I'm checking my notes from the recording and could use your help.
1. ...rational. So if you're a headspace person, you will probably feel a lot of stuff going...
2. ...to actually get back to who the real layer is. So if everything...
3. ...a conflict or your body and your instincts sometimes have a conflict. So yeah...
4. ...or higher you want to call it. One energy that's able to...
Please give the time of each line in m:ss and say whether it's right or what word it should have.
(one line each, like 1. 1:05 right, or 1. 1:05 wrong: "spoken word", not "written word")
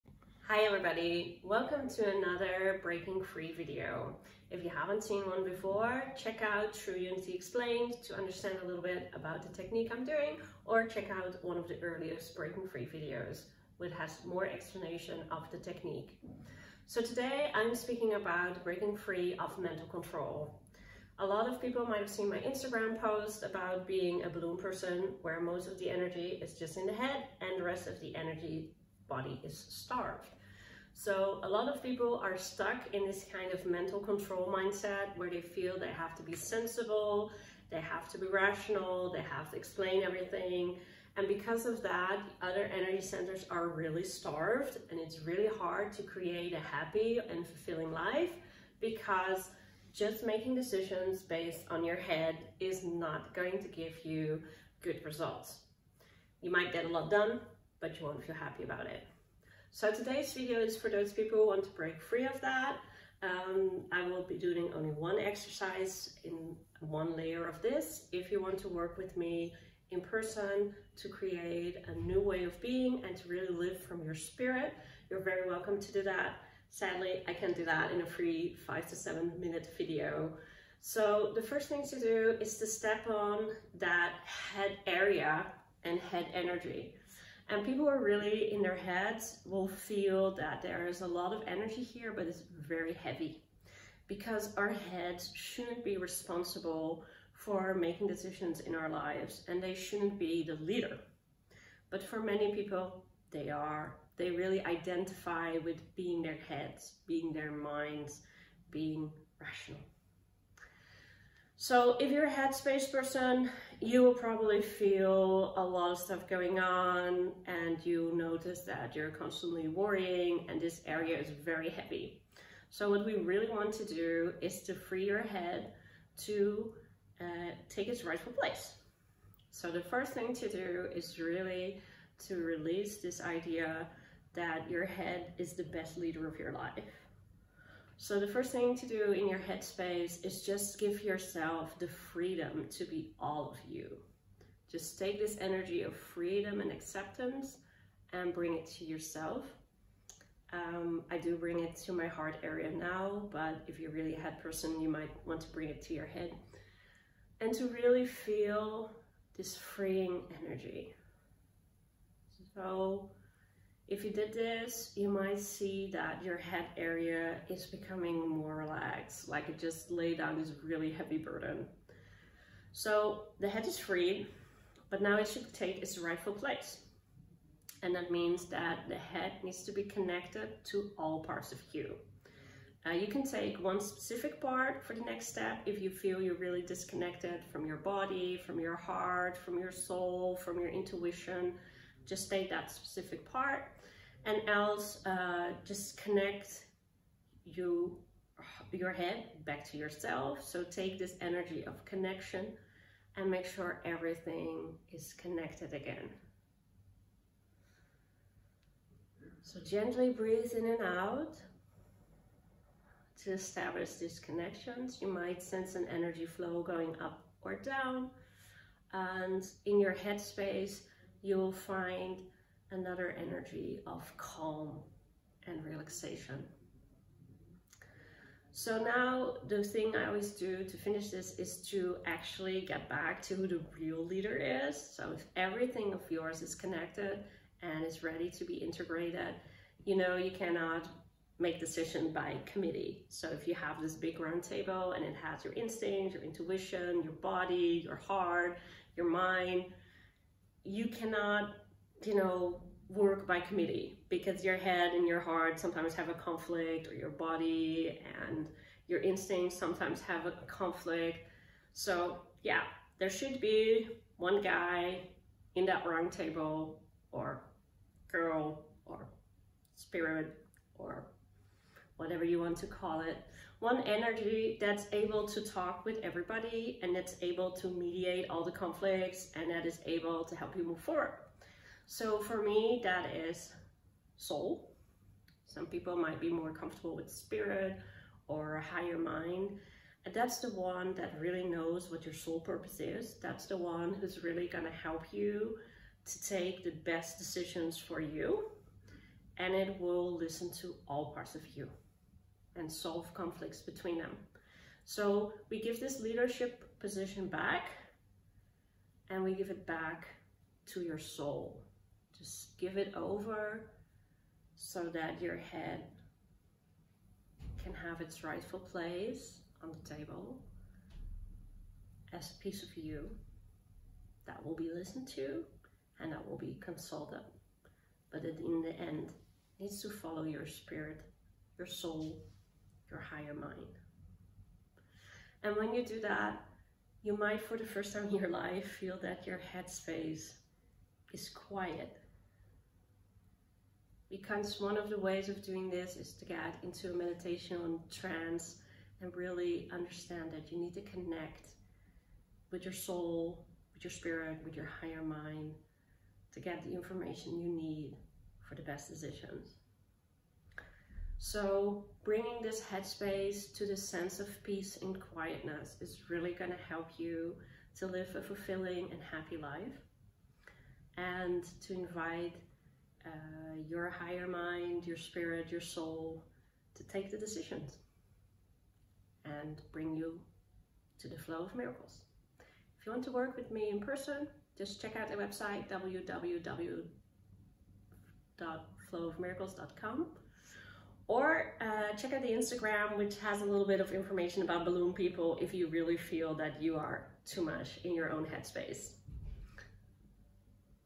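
1. 1:49 right
2. 3:51 wrong: "leader", not "layer"
3. 4:16 right
4. 4:30 wrong: "whatever", not "higher".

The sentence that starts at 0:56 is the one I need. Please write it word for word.
You might get a lot done, but you won't feel happy about it.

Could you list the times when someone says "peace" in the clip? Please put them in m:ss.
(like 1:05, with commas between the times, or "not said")
6:04.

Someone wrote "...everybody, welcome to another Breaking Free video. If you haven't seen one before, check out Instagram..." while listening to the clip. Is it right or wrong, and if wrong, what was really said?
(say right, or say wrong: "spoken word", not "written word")
wrong: "True", not "Instagram".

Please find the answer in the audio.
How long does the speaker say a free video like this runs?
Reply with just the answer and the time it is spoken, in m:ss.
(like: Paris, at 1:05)
5 to 7 minutes, at 1:18.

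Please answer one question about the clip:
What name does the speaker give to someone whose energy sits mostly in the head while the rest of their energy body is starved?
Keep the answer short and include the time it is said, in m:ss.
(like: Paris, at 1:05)
Balloon person, at 0:24.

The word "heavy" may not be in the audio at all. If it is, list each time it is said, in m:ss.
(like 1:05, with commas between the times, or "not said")
1:32, 2:01, 2:50.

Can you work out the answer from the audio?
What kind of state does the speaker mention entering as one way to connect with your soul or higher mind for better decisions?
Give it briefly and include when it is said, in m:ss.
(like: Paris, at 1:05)
Meditation trance, at 5:46.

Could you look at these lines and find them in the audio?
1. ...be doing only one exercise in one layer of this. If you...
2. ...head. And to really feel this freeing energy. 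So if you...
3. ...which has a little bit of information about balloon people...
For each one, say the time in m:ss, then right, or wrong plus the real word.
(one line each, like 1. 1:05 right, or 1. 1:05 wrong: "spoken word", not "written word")
1. 1:04 right
2. 2:36 right
3. 6:32 right.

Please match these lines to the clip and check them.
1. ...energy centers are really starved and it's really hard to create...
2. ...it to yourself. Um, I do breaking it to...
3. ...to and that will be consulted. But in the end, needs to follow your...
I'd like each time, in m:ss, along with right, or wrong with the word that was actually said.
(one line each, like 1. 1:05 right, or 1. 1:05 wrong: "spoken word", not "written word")
1. 0:42 right
2. 2:28 wrong: "bring", not "breaking"
3. 5:25 right.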